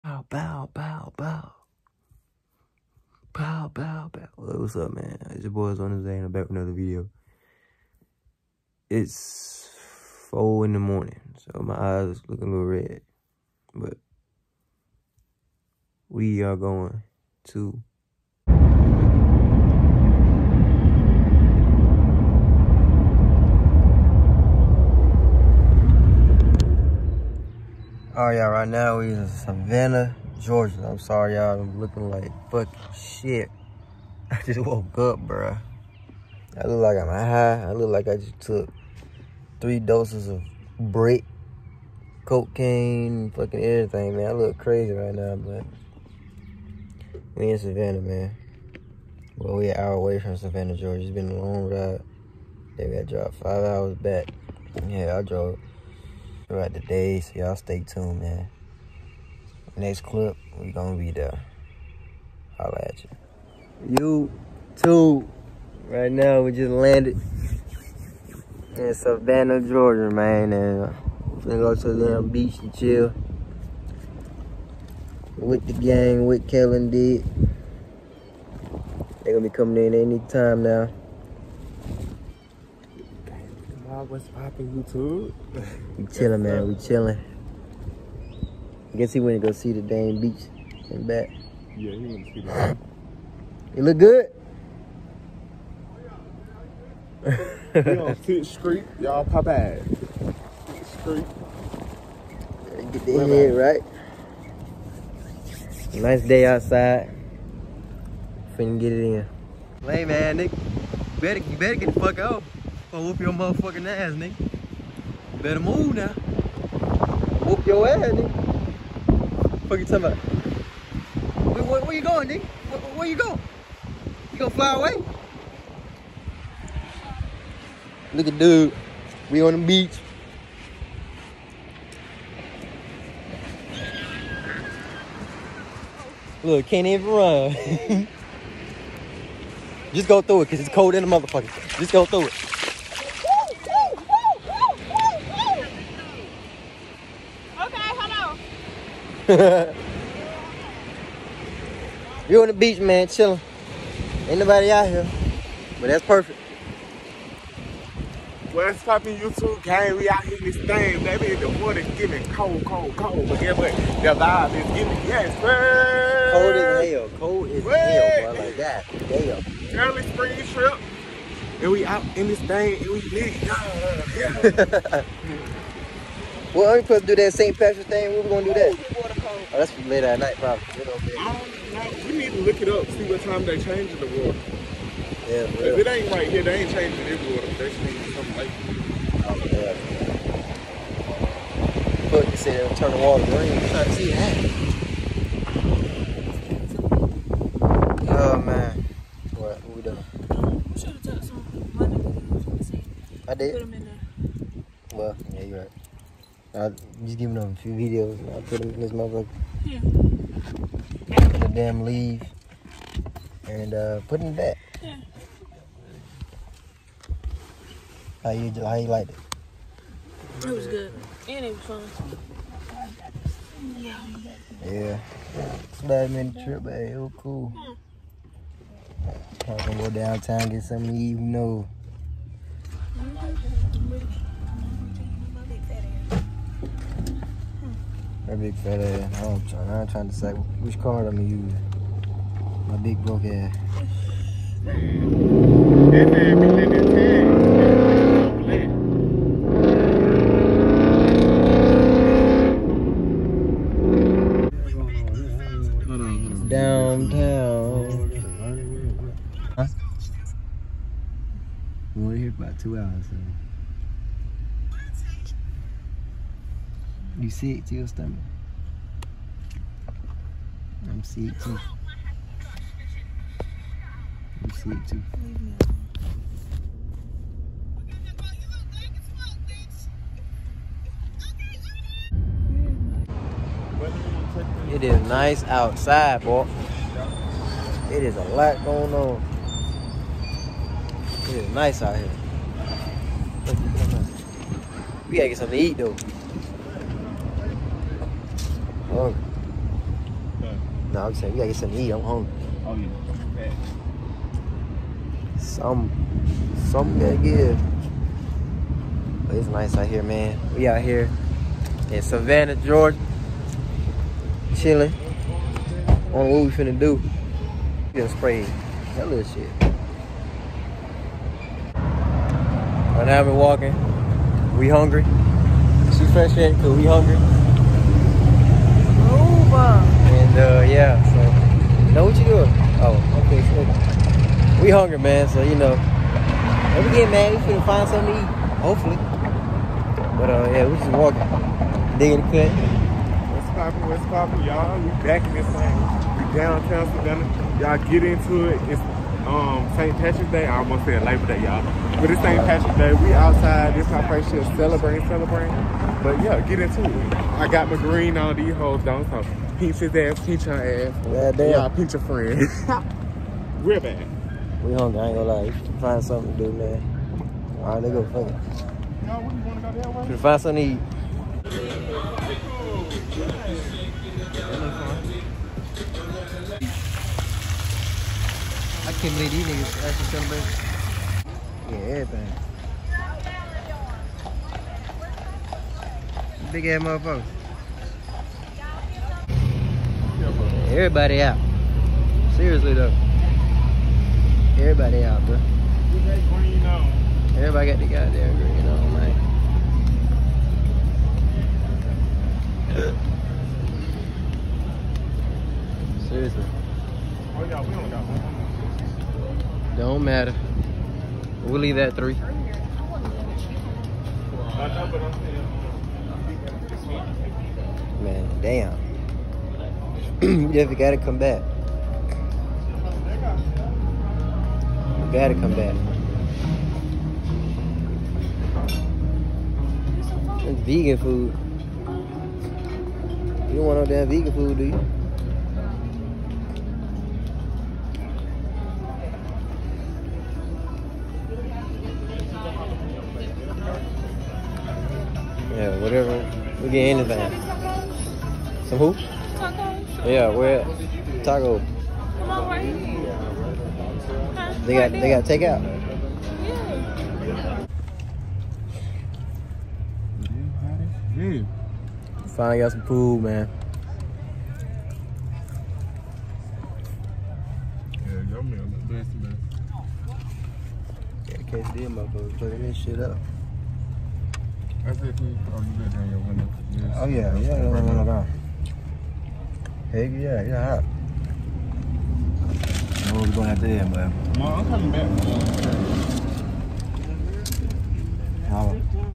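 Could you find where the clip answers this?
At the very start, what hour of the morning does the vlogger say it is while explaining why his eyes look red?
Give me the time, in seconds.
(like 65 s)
10 s.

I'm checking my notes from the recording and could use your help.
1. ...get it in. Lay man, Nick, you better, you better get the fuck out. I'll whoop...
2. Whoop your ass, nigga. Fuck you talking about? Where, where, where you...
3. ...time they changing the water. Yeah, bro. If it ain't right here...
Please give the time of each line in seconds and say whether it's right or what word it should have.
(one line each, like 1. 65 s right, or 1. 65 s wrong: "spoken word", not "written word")
1. 108 s right
2. 117 s right
3. 183 s right.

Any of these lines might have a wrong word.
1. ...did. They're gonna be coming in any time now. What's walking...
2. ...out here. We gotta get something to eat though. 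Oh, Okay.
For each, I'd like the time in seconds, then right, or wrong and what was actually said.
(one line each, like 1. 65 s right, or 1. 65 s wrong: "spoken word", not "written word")
1. 76 s wrong: "popping", not "walking"
2. 291 s right.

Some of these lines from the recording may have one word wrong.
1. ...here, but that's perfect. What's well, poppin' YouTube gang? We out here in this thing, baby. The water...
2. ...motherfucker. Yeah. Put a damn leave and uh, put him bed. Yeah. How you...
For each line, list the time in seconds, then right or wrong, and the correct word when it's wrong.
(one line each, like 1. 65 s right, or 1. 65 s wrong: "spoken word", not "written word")
1. 154 s right
2. 208 s right.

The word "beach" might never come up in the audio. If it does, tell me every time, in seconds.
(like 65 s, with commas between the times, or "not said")
72 s, 90 s, 129 s, 152 s.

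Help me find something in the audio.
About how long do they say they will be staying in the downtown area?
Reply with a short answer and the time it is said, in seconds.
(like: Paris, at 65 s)
2 hours, at 262 s.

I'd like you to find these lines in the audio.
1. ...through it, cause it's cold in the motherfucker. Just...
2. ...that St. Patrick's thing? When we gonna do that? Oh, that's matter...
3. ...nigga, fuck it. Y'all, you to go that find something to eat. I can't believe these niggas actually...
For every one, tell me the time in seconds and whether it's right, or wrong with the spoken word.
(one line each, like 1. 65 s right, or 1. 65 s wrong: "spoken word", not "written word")
1. 140 s right
2. 177 s wrong: "later", not "matter"
3. 367 s right.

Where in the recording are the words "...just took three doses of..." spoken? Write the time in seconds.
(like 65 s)
38 s.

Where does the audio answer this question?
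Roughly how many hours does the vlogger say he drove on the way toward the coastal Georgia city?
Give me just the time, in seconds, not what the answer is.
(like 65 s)
53 s.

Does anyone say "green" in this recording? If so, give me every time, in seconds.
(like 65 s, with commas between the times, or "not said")
193 s, 357 s, 398 s.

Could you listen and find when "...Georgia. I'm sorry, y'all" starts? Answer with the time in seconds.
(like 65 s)
30 s.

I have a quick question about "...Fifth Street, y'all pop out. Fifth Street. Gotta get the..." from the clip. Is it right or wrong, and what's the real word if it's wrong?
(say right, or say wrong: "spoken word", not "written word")
right.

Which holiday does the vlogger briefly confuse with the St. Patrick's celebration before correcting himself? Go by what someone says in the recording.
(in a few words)
Labor Day.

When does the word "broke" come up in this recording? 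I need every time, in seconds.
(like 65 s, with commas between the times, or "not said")
243 s.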